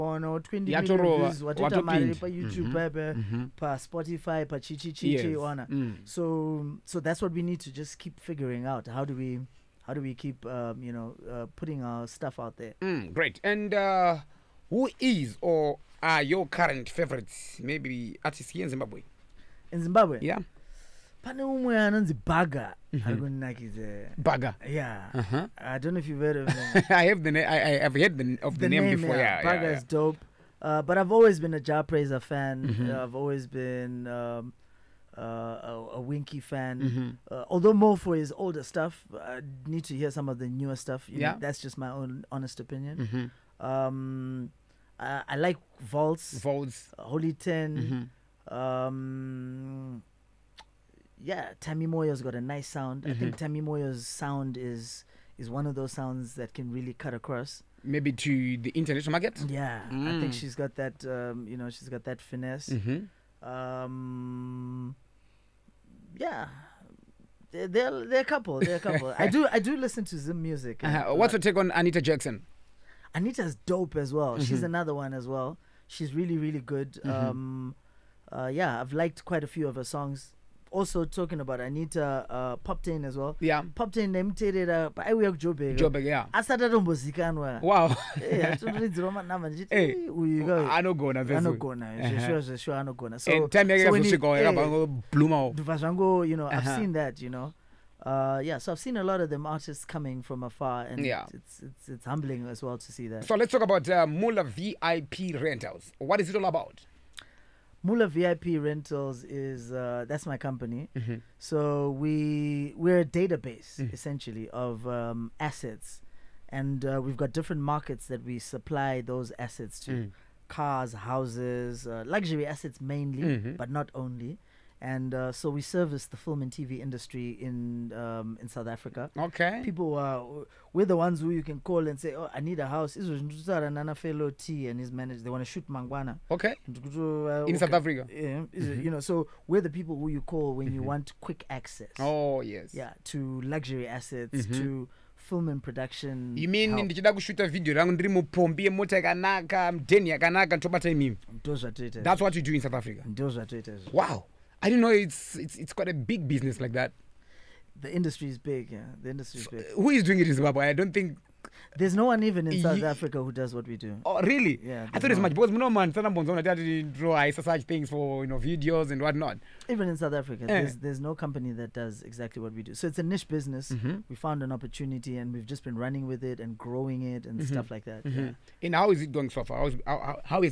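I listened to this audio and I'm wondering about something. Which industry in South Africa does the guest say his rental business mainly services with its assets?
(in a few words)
film and TV.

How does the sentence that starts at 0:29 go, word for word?
is dope uh, but i've always been a Jah Prayzah fan mm -hmm.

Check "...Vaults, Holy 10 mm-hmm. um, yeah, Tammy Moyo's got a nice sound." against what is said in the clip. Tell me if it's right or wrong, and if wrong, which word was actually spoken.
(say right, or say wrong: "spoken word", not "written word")
right.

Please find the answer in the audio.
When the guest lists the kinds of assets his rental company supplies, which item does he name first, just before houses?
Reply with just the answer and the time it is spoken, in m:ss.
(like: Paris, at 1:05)
cars, at 2:00.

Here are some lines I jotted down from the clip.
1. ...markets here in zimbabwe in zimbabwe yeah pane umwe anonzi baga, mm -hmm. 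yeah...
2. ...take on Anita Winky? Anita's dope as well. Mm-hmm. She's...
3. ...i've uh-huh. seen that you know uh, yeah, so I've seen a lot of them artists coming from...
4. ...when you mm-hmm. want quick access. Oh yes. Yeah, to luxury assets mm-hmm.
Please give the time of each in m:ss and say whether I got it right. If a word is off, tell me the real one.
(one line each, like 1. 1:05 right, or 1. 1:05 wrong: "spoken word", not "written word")
1. 0:18 wrong: "artists", not "markets"
2. 1:11 wrong: "Jaxson", not "Winky"
3. 1:36 right
4. 2:20 right.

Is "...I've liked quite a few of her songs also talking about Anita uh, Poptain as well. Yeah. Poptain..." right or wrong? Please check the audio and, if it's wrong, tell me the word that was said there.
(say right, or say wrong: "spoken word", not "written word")
right.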